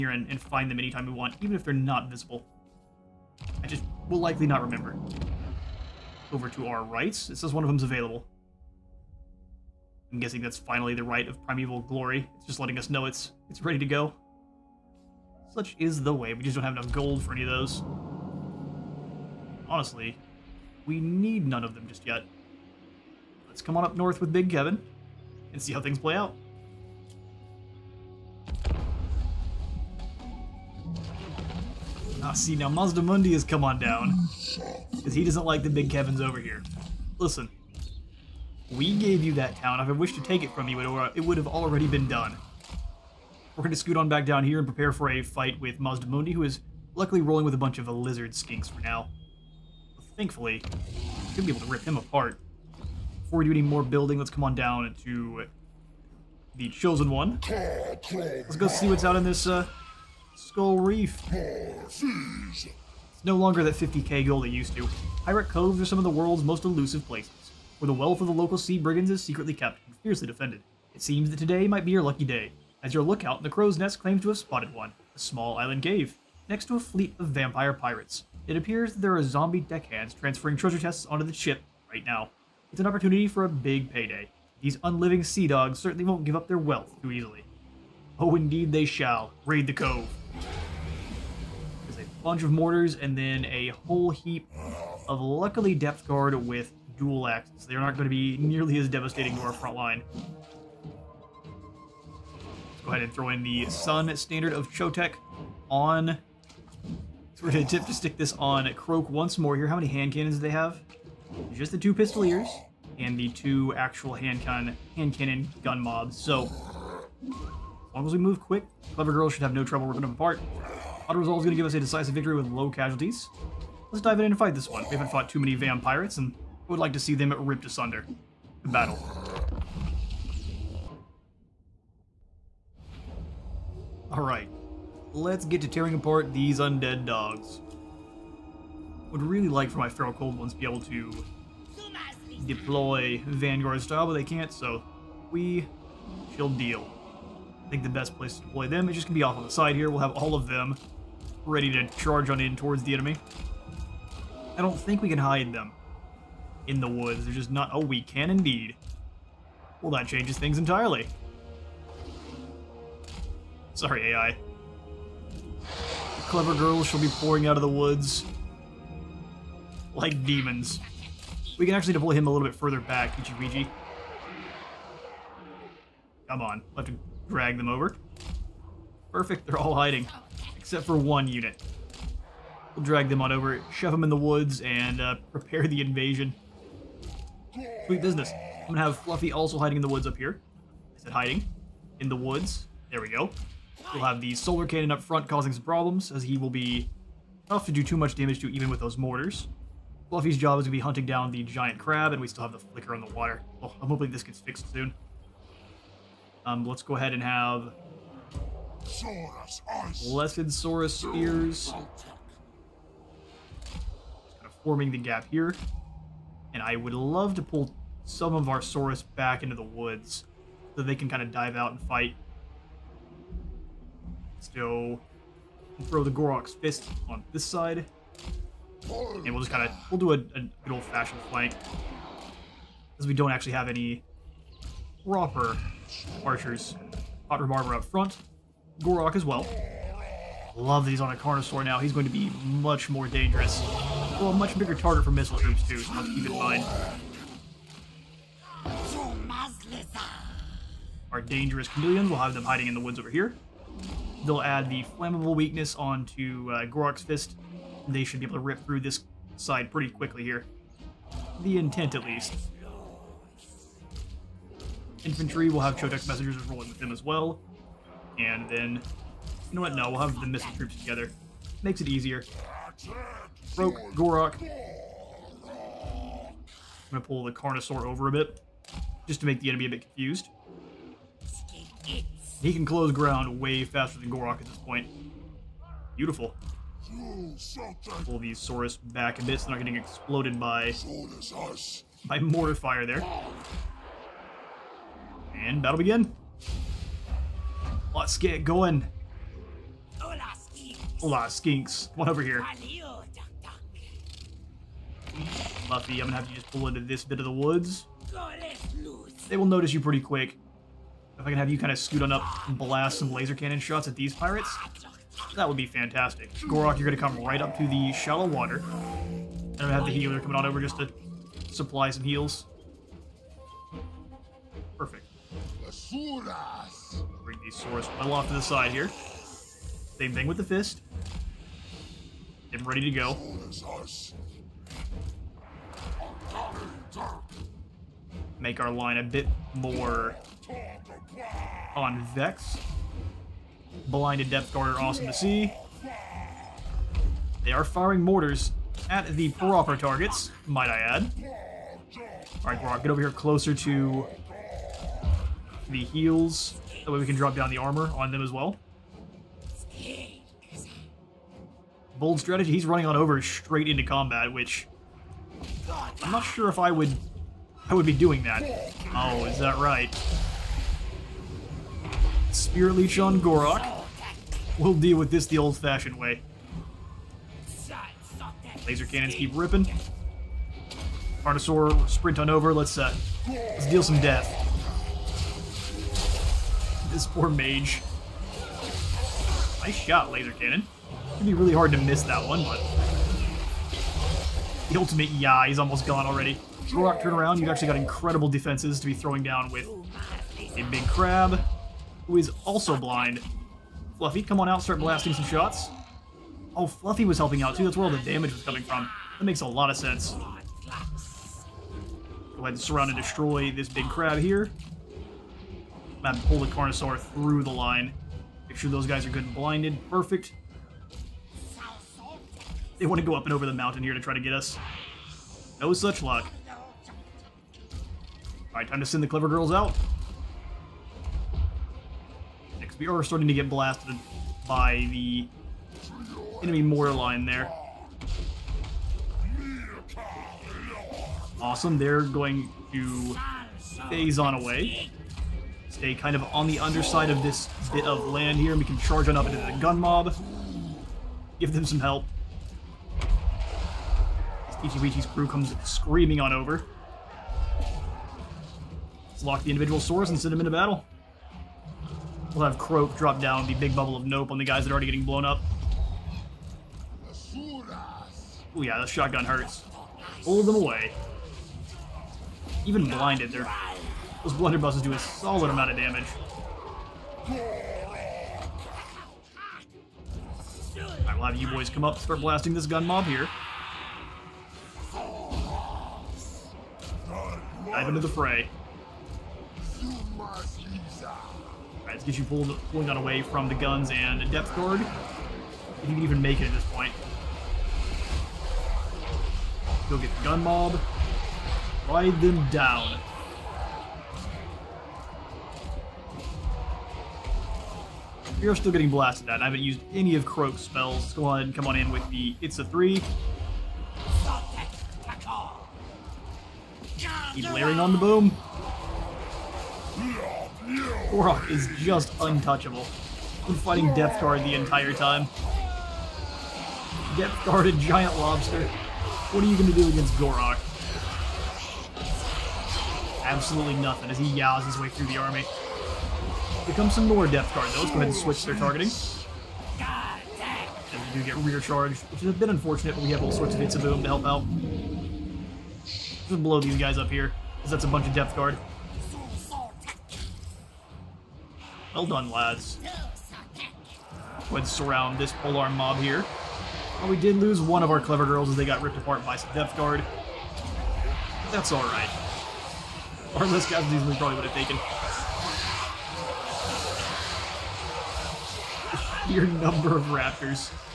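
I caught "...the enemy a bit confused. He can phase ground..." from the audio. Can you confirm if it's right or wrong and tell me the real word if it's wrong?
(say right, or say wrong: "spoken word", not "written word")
wrong: "close", not "phase".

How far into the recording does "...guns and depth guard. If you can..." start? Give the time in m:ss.
8:13.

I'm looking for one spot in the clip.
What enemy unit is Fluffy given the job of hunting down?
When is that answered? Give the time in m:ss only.
3:21.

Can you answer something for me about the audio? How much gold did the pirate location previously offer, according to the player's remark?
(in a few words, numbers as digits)
50k.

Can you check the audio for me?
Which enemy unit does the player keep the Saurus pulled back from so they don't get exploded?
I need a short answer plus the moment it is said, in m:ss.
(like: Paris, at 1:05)
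Mortifier, at 4:52.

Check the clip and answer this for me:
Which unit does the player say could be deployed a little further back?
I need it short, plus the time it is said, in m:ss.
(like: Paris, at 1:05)
Ichibiji, at 2:53.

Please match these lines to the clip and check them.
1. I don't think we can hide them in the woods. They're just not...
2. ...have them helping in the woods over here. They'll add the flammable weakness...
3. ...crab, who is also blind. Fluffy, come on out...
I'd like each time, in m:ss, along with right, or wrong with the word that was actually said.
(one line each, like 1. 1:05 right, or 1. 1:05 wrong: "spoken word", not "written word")
1. 2:34 right
2. 4:12 wrong: "hiding", not "helping"
3. 6:40 right.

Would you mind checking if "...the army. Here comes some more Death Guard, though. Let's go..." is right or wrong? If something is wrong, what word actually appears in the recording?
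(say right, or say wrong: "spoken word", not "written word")
right.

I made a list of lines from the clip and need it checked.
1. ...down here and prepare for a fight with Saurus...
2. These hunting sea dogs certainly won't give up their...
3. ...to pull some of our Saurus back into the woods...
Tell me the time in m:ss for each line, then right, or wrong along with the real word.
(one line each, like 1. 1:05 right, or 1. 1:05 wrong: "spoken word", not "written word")
1. 0:44 wrong: "Mazdamundi", not "Saurus"
2. 1:24 wrong: "unliving", not "hunting"
3. 3:37 right.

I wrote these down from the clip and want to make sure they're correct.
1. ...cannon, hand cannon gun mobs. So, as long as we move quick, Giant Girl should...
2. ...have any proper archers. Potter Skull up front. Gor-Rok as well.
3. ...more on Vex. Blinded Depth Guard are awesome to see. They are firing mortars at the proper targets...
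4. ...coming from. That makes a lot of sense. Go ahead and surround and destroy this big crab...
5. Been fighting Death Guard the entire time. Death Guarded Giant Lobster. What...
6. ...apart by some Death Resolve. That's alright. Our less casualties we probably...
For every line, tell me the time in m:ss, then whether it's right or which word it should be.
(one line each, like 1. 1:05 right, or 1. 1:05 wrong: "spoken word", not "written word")
1. 1:54 wrong: "Clever", not "Giant"
2. 3:53 wrong: "Barber", not "Skull"
3. 5:39 right
4. 6:48 right
5. 8:43 right
6. 9:18 wrong: "Guard", not "Resolve".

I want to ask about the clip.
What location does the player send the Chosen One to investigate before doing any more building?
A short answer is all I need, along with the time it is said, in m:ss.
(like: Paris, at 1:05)
Skull Reef, at 1:00.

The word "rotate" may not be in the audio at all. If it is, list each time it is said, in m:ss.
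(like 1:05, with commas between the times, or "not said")
not said.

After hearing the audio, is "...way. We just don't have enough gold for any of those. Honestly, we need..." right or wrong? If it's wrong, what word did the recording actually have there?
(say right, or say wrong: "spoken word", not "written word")
right.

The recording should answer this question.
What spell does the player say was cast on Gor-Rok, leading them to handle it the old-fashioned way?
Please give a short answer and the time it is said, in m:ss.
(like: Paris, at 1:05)
Spear Leech, at 6:12.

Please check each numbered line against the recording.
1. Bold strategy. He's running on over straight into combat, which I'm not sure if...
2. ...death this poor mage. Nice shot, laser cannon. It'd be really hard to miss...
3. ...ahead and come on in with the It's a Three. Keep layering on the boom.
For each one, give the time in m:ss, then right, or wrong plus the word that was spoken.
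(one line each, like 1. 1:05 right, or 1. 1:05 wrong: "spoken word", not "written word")
1. 6:01 right
2. 6:24 right
3. 8:31 right.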